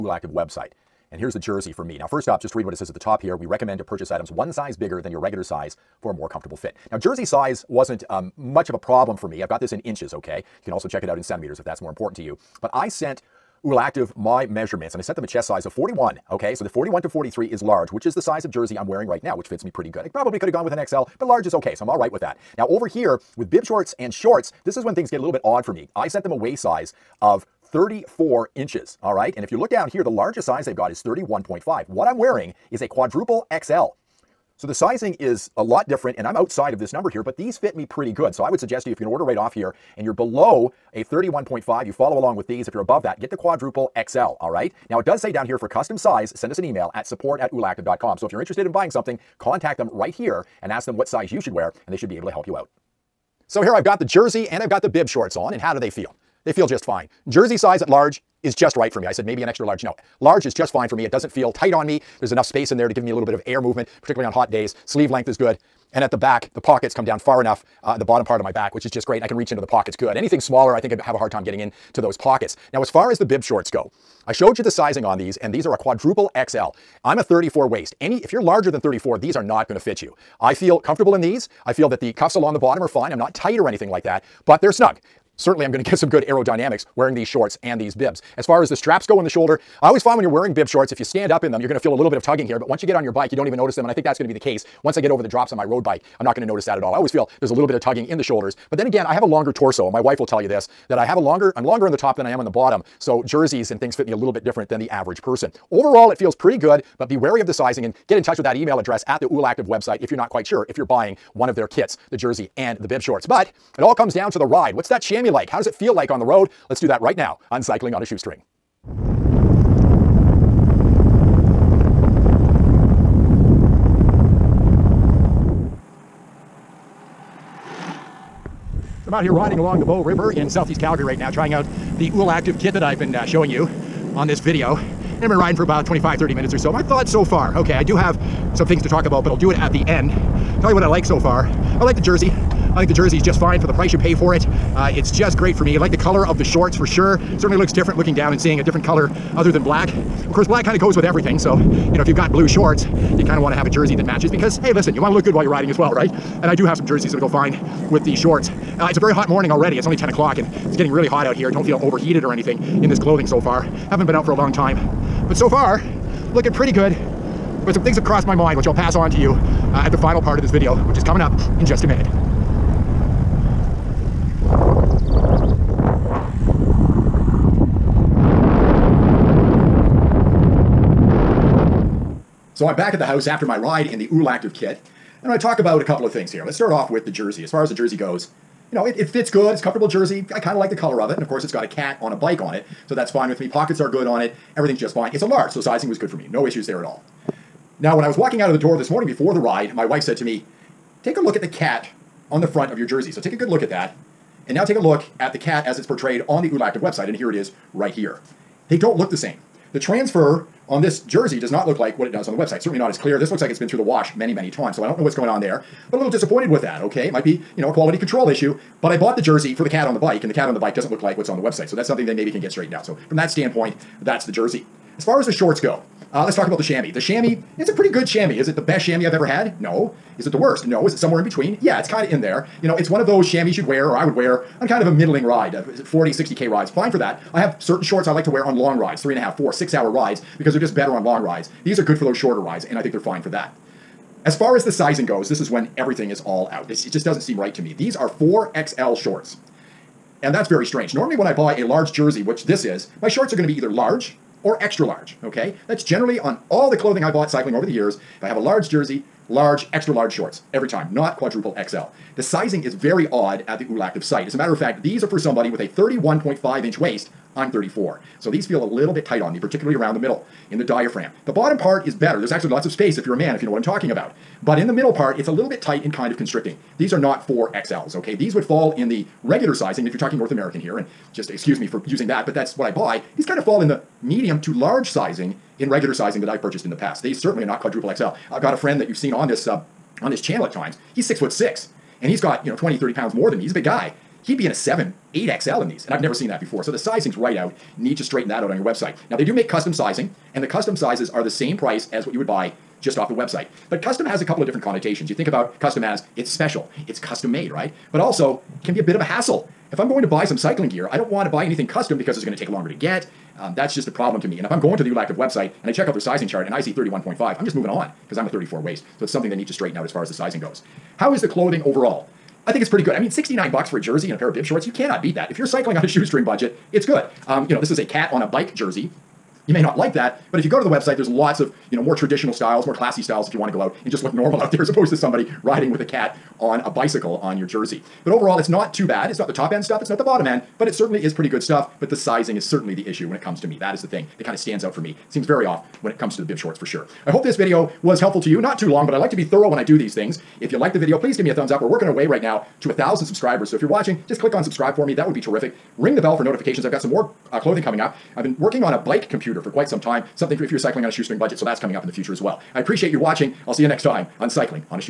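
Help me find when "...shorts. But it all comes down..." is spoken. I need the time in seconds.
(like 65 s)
113 s.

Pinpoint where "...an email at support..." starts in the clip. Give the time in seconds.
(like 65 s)
46 s.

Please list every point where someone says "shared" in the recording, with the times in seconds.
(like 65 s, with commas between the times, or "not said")
not said.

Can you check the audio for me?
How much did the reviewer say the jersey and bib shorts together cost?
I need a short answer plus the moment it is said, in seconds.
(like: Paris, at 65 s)
$69, at 323 s.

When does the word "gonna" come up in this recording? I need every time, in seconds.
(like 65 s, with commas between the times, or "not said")
39 s, 79 s.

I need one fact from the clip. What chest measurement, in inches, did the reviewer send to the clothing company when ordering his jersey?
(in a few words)
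41.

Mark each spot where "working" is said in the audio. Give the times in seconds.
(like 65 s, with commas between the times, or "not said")
351 s, 358 s.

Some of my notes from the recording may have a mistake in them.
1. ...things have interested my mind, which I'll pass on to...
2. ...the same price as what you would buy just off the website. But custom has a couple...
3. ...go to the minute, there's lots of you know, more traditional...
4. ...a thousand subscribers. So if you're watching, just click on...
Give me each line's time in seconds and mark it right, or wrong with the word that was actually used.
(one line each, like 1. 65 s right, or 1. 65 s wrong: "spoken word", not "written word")
1. 167 s wrong: "crossed", not "interested"
2. 301 s right
3. 330 s wrong: "website", not "minute"
4. 352 s right.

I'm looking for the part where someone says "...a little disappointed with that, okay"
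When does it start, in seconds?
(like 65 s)
215 s.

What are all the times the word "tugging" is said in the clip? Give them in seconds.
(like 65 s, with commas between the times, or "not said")
92 s, 97 s.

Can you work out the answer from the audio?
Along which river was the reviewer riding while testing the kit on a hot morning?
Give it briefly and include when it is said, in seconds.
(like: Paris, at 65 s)
Bow River, at 129 s.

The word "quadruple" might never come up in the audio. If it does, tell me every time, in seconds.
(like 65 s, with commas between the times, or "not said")
32 s, 43 s, 75 s, 261 s, 287 s.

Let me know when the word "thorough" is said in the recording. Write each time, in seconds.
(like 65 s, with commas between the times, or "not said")
349 s.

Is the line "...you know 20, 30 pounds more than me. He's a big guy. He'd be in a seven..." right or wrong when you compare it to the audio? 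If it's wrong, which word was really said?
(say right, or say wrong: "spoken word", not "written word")
right.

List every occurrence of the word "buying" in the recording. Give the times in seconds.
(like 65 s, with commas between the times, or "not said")
48 s, 110 s.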